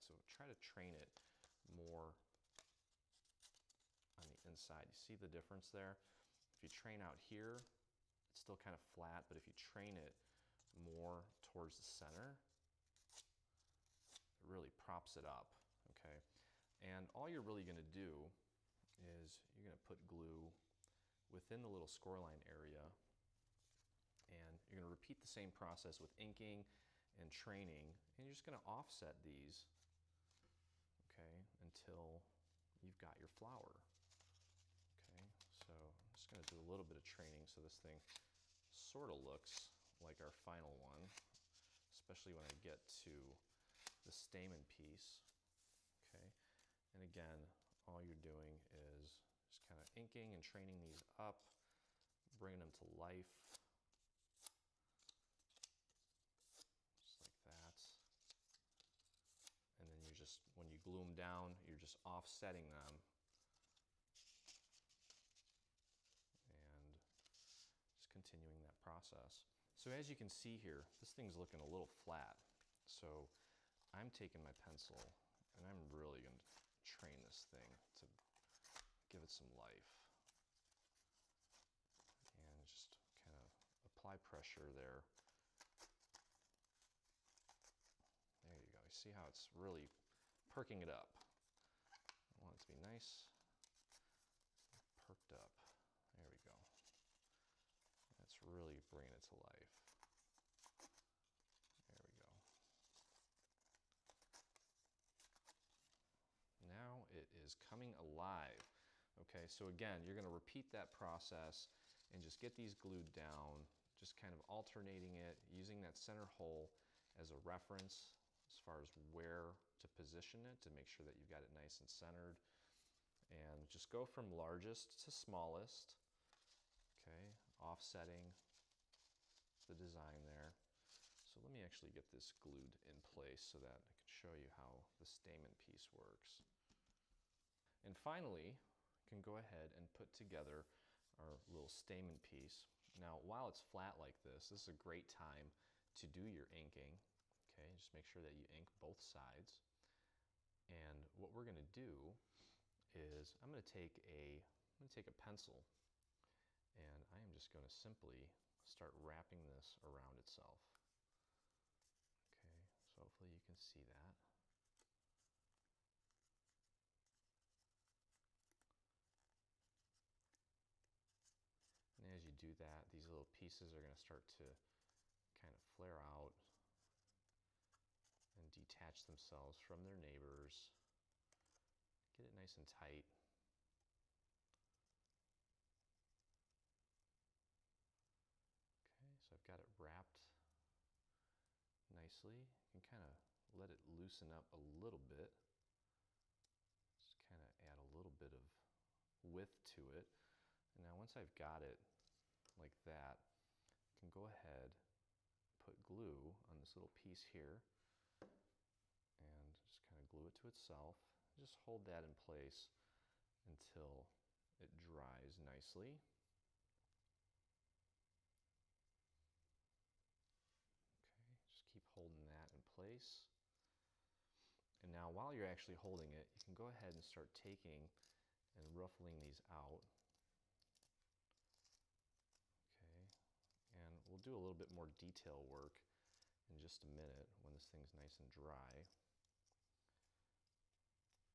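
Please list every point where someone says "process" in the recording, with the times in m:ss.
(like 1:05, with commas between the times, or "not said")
0:25, 1:08, 1:50.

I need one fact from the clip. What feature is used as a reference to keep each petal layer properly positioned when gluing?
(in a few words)
center hole.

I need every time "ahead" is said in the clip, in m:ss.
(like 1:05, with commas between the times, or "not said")
2:19, 3:24, 3:46.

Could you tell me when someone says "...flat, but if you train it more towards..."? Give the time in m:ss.
0:08.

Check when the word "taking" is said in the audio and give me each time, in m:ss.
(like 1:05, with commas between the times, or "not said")
1:14, 3:47.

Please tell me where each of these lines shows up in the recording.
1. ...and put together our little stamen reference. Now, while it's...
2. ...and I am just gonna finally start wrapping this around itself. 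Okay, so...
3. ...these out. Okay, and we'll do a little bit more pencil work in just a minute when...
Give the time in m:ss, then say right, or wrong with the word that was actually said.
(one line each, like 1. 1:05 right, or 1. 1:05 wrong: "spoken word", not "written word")
1. 2:19 wrong: "piece", not "reference"
2. 2:36 wrong: "simply", not "finally"
3. 3:49 wrong: "detail", not "pencil".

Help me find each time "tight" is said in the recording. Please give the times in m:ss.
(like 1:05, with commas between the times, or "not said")
3:02.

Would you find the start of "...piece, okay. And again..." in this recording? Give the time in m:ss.
0:44.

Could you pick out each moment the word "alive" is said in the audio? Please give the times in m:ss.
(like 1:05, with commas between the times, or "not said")
1:47.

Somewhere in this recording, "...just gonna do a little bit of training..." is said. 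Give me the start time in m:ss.
0:36.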